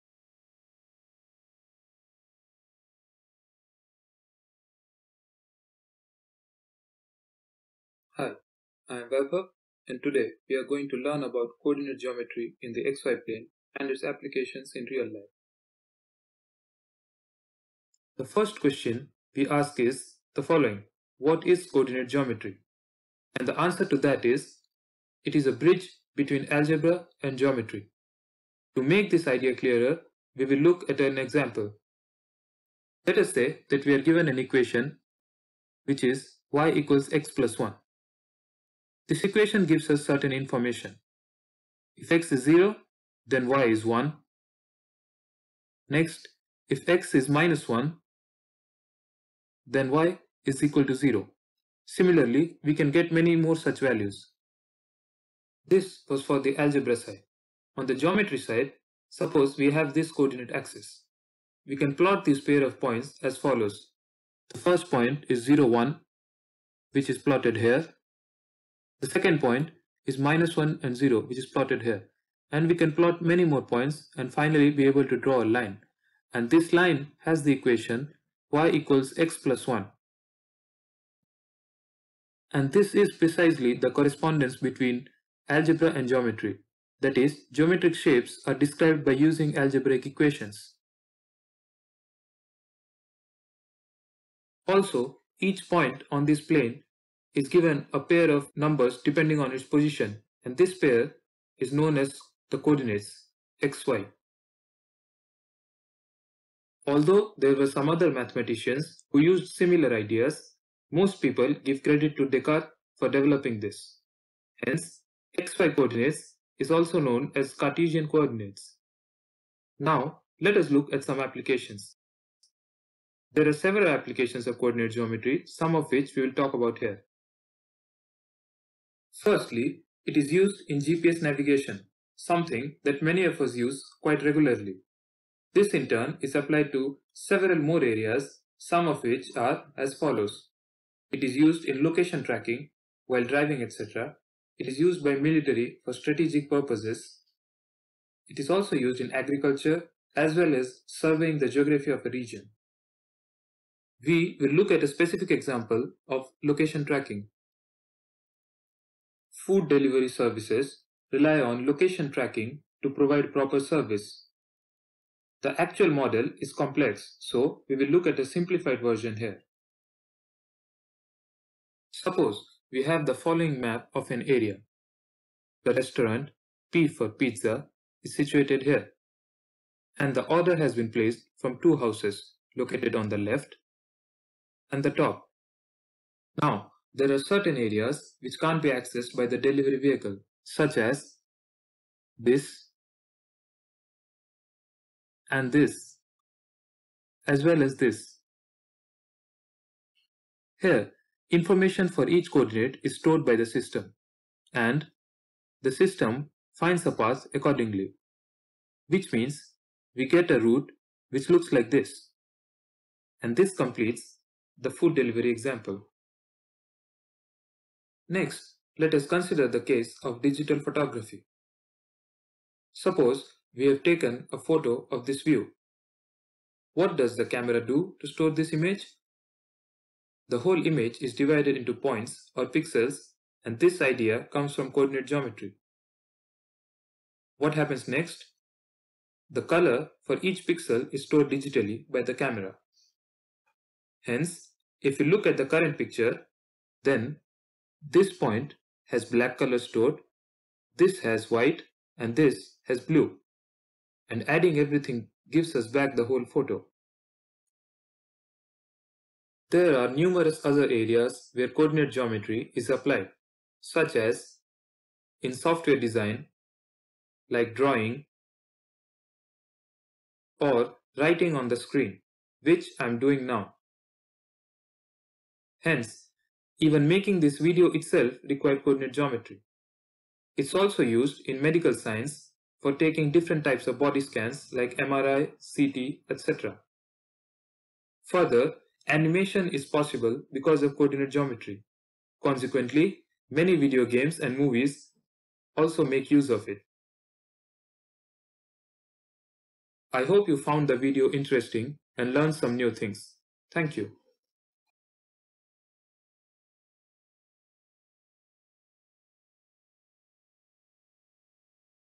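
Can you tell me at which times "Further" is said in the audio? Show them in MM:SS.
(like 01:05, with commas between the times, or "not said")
04:48.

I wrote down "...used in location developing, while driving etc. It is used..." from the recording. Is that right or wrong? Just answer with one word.
wrong.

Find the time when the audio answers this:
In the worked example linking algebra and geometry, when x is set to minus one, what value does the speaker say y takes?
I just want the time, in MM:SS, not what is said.
00:49.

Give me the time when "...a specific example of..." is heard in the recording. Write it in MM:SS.
02:34.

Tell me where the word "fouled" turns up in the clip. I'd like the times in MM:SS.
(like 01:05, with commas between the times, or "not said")
not said.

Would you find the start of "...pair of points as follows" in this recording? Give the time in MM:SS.
01:02.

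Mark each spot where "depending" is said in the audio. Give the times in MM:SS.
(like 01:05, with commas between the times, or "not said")
01:39.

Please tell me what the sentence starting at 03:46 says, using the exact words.
What does the camera do to store this image?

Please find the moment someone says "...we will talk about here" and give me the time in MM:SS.
02:06.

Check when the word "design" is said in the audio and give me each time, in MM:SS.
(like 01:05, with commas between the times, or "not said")
04:25.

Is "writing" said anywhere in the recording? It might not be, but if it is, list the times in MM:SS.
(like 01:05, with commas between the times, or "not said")
04:30.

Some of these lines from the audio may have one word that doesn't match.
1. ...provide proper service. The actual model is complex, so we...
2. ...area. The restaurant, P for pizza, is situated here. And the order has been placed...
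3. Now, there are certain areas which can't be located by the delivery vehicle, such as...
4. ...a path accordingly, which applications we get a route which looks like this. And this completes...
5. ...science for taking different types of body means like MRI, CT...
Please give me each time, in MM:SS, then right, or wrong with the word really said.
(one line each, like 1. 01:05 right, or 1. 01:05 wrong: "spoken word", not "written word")
1. 02:42 right
2. 02:54 right
3. 03:06 wrong: "accessed", not "located"
4. 03:26 wrong: "means", not "applications"
5. 04:41 wrong: "scans", not "means".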